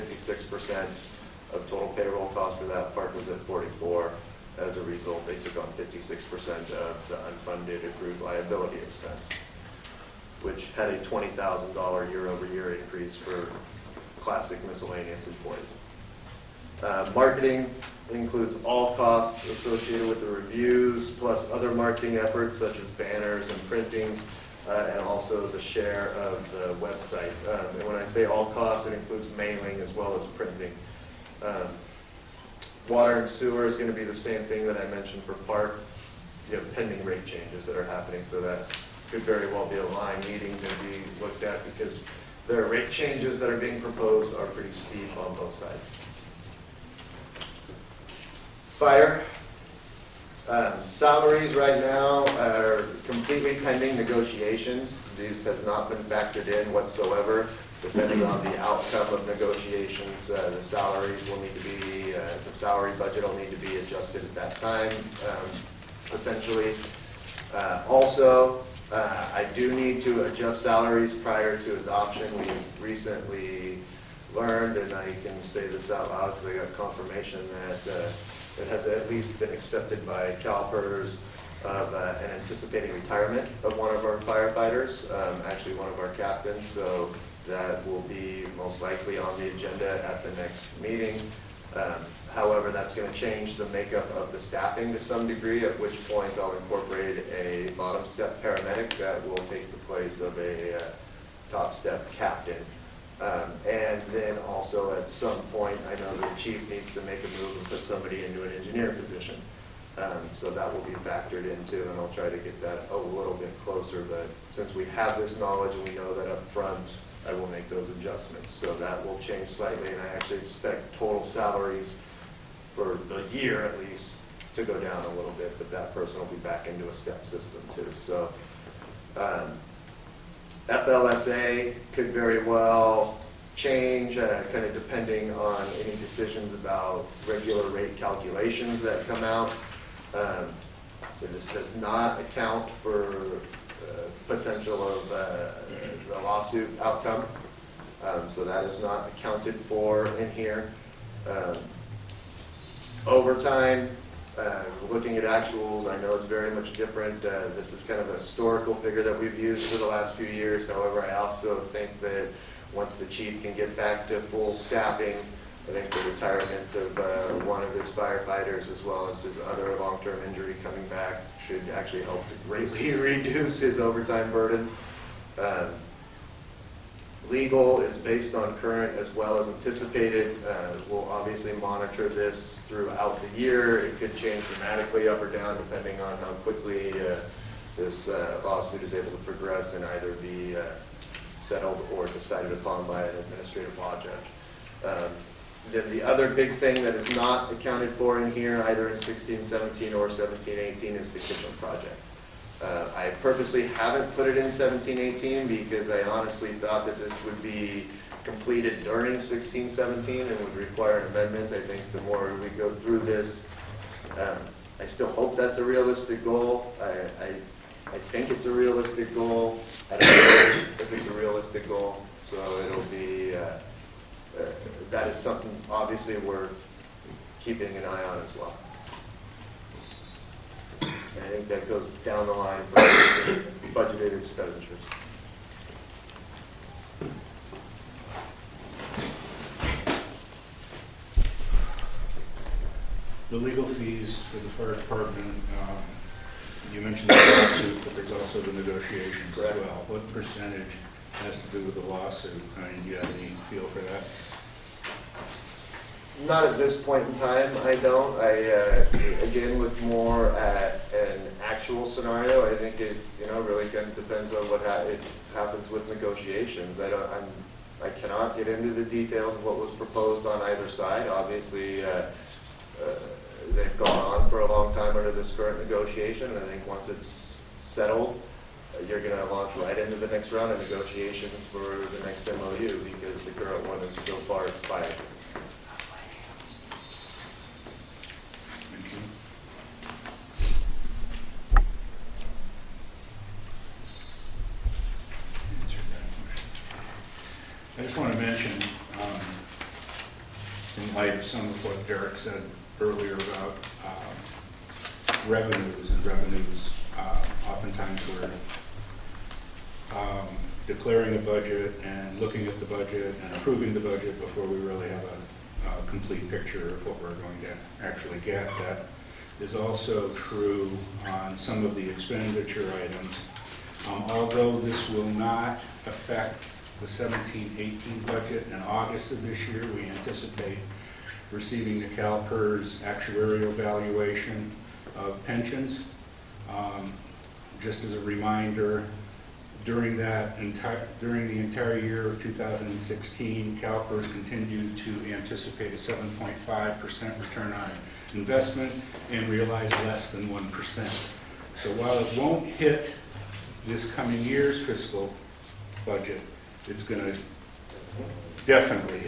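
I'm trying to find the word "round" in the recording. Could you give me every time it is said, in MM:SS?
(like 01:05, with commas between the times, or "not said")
04:40.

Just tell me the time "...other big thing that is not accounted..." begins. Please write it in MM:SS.
03:16.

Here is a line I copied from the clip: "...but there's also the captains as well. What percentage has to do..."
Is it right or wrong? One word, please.
wrong.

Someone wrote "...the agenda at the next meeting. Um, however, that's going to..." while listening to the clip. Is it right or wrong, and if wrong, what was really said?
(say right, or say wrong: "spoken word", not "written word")
right.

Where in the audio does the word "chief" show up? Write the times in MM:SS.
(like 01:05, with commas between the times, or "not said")
01:46, 02:43.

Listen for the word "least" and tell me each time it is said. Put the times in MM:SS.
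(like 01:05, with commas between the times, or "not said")
01:19, 02:03.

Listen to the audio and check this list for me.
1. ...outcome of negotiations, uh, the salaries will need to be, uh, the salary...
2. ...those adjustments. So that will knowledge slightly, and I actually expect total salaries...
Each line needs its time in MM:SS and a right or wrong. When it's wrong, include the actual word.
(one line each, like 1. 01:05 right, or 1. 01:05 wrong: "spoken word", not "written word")
1. 00:58 right
2. 01:57 wrong: "change", not "knowledge".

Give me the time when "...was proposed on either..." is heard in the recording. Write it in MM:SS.
04:29.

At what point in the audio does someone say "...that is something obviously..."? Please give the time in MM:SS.
03:44.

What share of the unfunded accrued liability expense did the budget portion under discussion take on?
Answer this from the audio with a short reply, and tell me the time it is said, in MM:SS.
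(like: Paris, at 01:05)
56%, at 00:05.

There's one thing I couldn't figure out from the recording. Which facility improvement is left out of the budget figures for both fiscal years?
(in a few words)
kitchen project.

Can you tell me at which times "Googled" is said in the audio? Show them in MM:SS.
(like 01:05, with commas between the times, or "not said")
not said.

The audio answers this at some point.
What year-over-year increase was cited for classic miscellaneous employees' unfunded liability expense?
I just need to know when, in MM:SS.
00:10.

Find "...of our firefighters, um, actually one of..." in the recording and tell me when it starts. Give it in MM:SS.
01:23.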